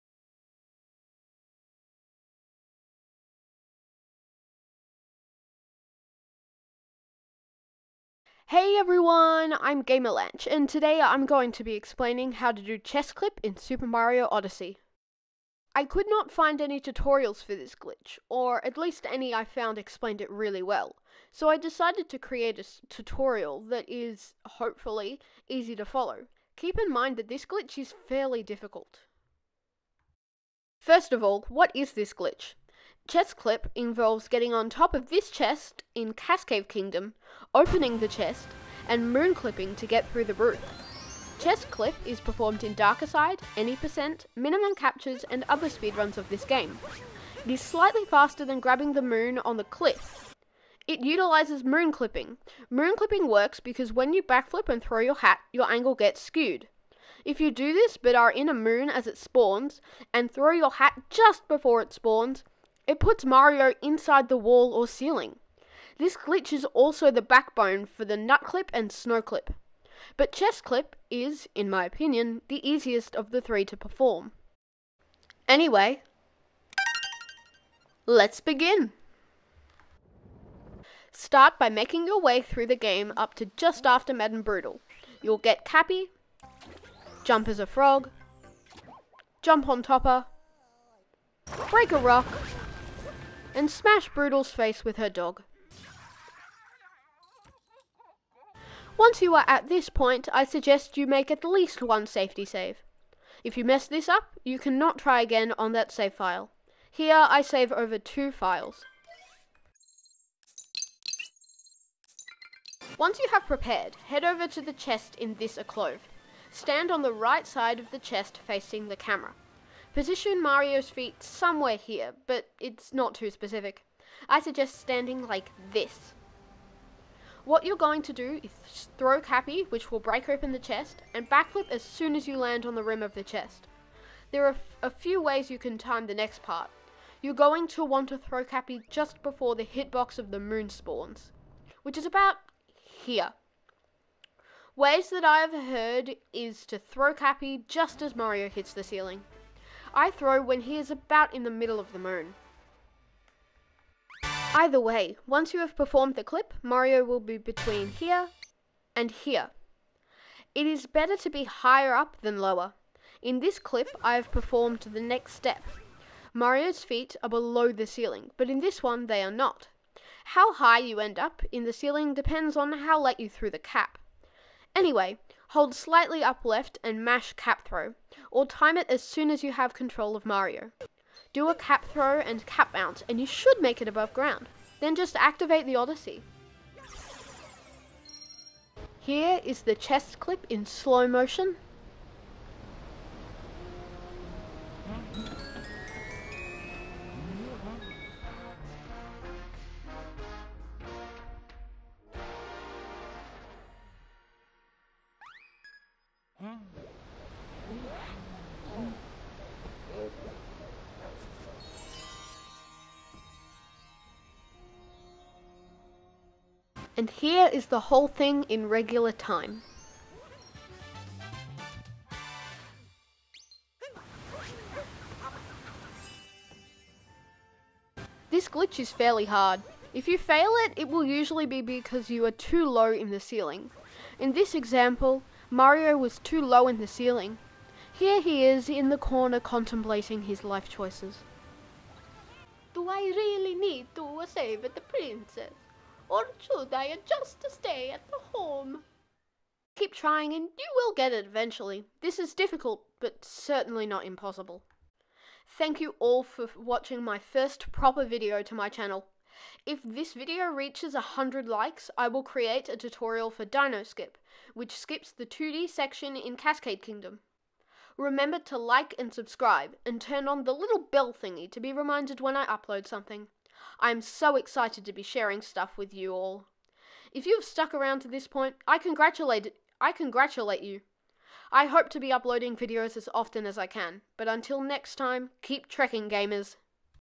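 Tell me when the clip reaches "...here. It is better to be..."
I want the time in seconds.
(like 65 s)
159 s.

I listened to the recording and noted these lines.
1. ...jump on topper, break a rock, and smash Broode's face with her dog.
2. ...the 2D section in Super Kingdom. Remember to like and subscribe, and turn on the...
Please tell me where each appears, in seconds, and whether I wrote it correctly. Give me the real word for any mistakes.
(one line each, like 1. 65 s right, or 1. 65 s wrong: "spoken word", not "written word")
1. 89 s right
2. 265 s wrong: "Cascade", not "Super".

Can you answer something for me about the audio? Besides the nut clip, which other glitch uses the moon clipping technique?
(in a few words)
snow clip.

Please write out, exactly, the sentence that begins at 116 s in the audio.
Stand on the right side of the chest facing the camera.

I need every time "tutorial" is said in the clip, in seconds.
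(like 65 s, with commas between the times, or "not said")
16 s, 22 s, 262 s.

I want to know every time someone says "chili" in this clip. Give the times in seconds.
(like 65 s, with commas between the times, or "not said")
not said.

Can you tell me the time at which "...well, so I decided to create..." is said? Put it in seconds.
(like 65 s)
20 s.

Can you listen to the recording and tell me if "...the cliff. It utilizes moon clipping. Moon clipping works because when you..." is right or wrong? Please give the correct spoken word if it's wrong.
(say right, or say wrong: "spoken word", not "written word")
right.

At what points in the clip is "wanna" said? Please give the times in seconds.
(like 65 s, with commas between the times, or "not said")
not said.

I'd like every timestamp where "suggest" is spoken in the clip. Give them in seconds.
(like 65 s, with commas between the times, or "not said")
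100 s, 124 s.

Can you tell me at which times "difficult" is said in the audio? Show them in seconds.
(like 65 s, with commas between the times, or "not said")
28 s, 252 s.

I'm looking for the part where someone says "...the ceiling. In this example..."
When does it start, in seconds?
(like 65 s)
233 s.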